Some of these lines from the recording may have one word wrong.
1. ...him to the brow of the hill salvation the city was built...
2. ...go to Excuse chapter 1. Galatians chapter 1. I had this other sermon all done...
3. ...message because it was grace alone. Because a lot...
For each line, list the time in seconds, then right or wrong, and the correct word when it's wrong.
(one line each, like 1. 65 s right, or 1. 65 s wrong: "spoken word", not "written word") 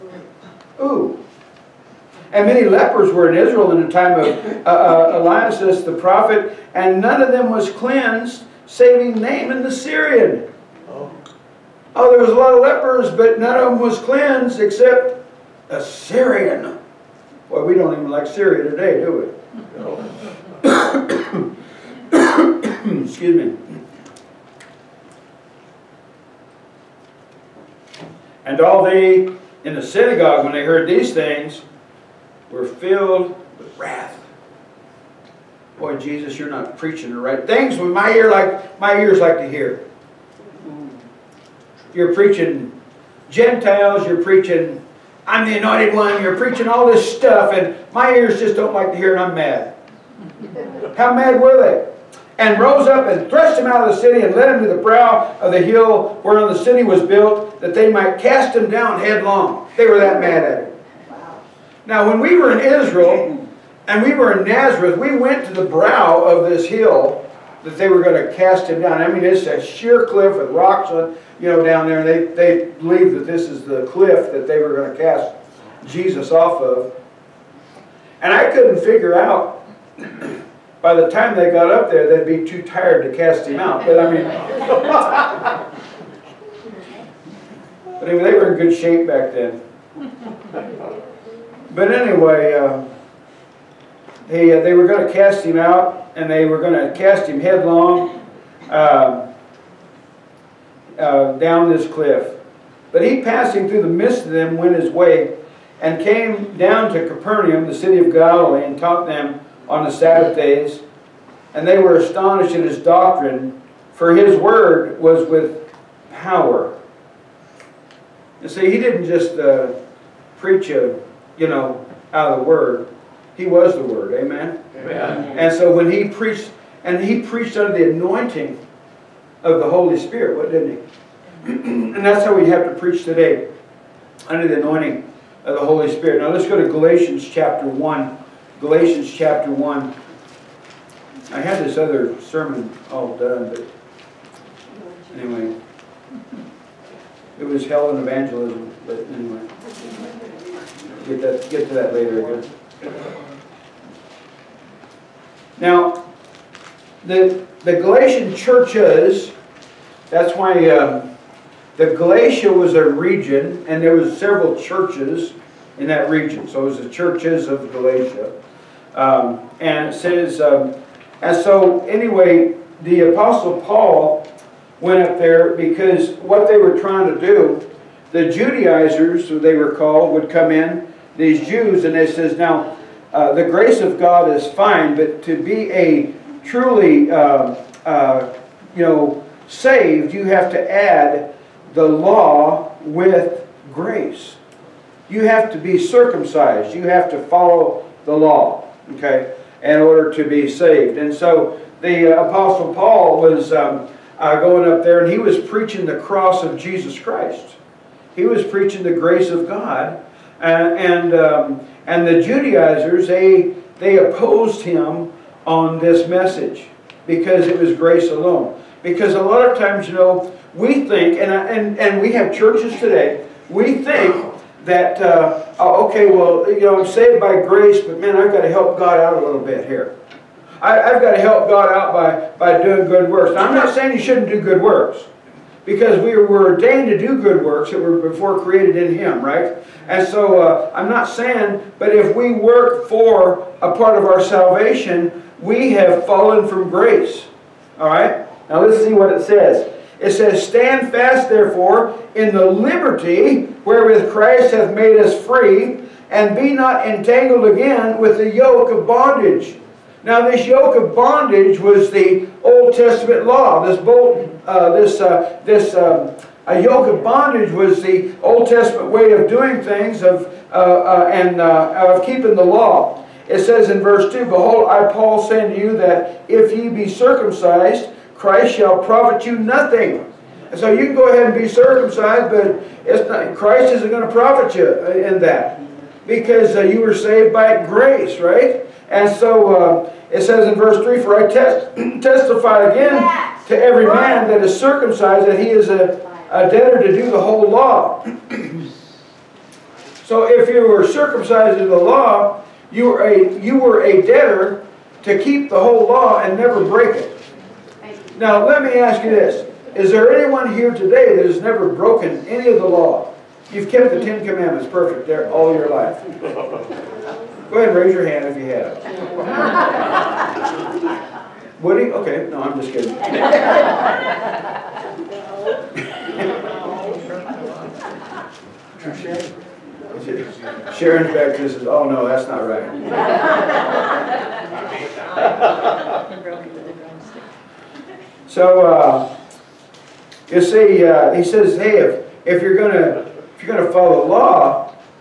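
1. 54 s wrong: "whereon", not "salvation"
2. 136 s wrong: "Galatians", not "Excuse"
3. 216 s right.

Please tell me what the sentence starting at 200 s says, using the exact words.
And so the Apostle Paul was um, uh, going up there and he was preaching the cross of Jesus Christ.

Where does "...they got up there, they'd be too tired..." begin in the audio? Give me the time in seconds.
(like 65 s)
81 s.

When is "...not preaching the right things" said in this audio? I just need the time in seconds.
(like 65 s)
36 s.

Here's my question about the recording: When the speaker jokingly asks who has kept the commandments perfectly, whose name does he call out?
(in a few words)
Woody.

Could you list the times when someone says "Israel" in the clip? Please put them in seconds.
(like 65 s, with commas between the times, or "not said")
3 s, 62 s.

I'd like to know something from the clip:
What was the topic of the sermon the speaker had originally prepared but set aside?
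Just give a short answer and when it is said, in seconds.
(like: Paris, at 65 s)
Hell and evangelism, at 147 s.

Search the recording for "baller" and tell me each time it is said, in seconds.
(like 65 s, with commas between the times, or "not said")
not said.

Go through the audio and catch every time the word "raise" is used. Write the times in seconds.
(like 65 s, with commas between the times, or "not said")
317 s.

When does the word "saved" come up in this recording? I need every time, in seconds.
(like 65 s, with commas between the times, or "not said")
189 s, 200 s, 226 s, 286 s.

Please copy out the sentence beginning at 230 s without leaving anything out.
I, have got to help God out by, by doing good works.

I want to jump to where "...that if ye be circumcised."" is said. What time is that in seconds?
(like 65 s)
275 s.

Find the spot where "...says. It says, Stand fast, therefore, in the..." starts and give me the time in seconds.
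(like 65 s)
249 s.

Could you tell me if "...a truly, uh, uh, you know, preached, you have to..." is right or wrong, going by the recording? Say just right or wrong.
wrong.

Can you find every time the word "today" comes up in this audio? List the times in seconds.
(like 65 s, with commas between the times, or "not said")
18 s, 133 s, 222 s, 310 s.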